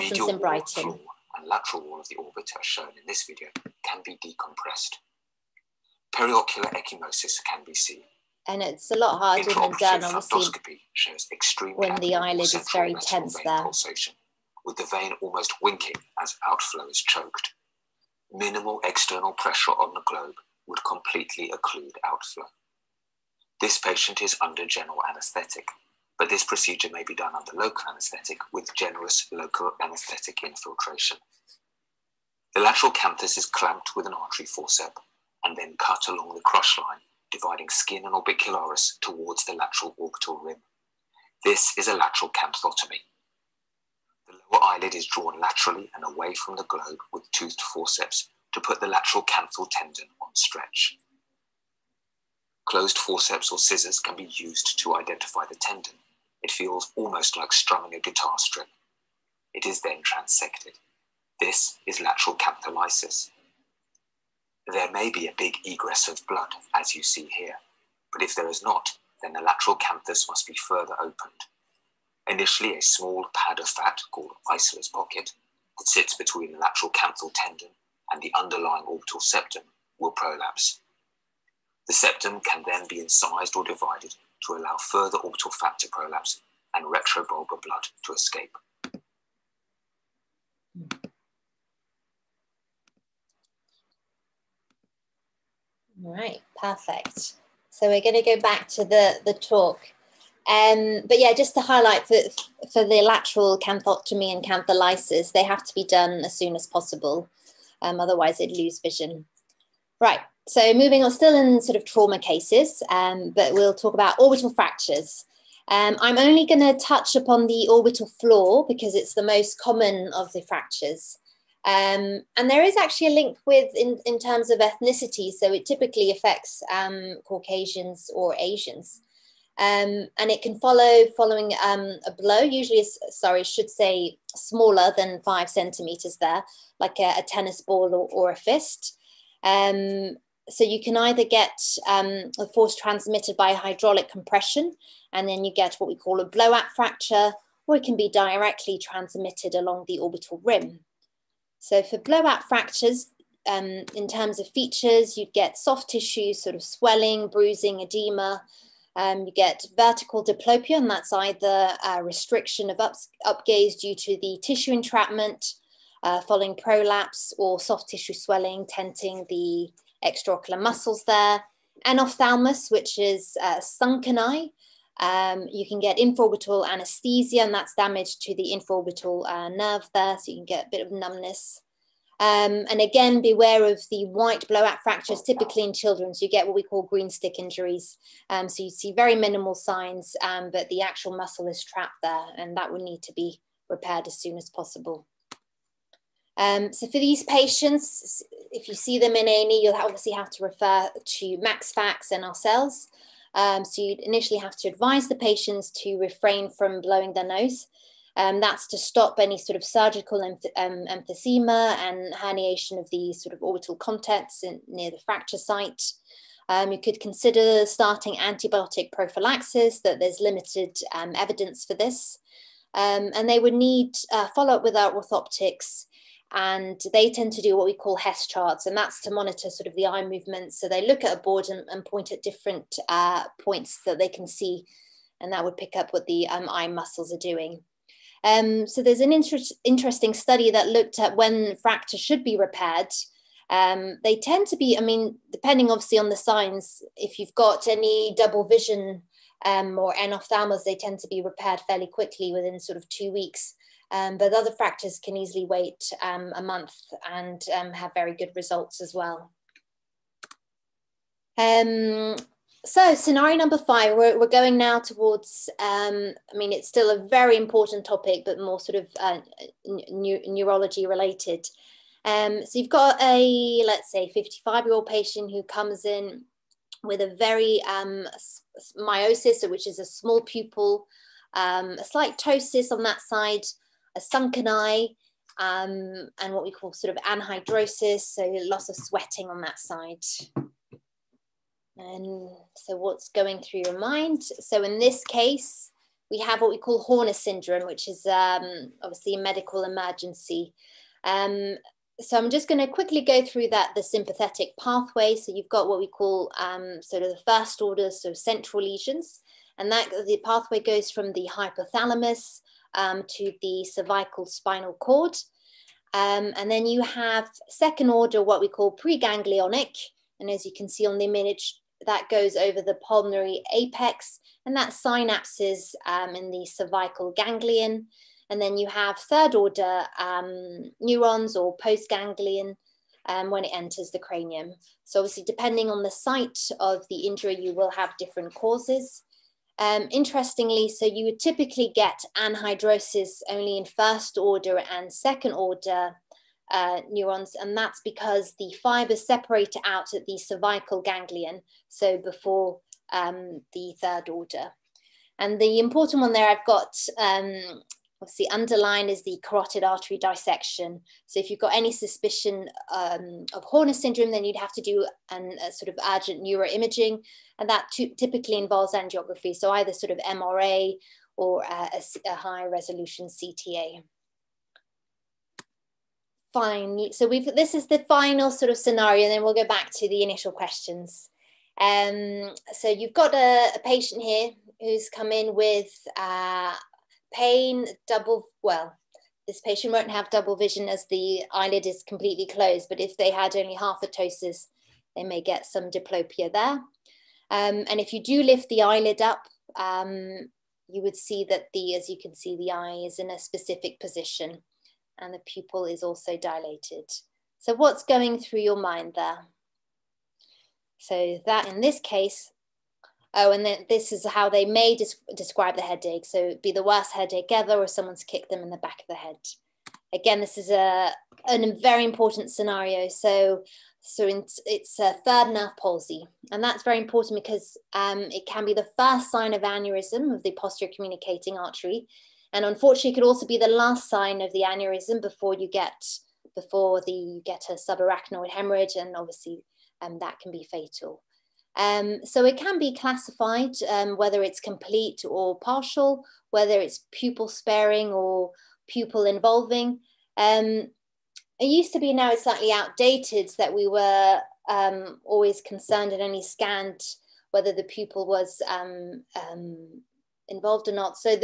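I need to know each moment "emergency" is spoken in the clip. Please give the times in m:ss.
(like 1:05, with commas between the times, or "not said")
4:59.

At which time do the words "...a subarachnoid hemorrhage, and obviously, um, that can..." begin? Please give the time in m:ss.
7:17.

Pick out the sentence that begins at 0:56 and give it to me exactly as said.
It feels almost like strumming a guitar string.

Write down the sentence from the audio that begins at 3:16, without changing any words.
Um, so for these patients, if you see them in A&E, you'll obviously have to refer to MaxFax and ourselves.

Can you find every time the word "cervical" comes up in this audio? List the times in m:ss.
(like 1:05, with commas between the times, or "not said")
5:13, 5:26, 5:50.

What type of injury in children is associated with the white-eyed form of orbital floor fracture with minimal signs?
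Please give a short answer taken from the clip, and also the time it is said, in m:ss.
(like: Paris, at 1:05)
Green stick injuries, at 3:06.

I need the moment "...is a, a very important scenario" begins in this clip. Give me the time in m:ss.
7:00.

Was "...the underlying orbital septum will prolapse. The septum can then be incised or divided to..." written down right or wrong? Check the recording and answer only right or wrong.
right.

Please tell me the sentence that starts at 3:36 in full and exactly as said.
Um, you could consider starting antibiotic prophylaxis, that there's limited um, evidence for this.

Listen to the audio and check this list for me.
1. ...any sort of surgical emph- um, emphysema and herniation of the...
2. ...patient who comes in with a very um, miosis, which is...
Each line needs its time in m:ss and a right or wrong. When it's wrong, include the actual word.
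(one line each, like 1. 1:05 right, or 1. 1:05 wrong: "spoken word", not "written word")
1. 3:29 right
2. 4:34 right.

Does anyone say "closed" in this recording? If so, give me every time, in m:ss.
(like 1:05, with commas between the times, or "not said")
0:52, 6:32.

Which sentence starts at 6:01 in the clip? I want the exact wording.
So if you've got any suspicion um, of Horner syndrome, then you'd have to do an, a sort of urgent neuroimaging.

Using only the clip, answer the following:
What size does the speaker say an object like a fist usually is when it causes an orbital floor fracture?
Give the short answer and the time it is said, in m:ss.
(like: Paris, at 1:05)
Smaller than 5 centimeters, at 2:14.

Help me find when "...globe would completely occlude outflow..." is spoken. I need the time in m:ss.
0:20.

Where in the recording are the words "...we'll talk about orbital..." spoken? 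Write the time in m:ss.
1:53.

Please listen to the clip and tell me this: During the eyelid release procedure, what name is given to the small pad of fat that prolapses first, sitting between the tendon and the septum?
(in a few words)
Eisler's pocket.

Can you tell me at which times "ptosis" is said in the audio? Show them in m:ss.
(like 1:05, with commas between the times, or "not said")
4:42, 6:33.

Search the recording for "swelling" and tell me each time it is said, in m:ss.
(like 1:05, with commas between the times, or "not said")
2:36, 2:48.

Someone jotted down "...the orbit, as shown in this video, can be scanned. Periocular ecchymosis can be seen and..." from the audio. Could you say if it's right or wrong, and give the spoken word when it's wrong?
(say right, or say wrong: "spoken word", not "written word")
wrong: "decompressed", not "scanned".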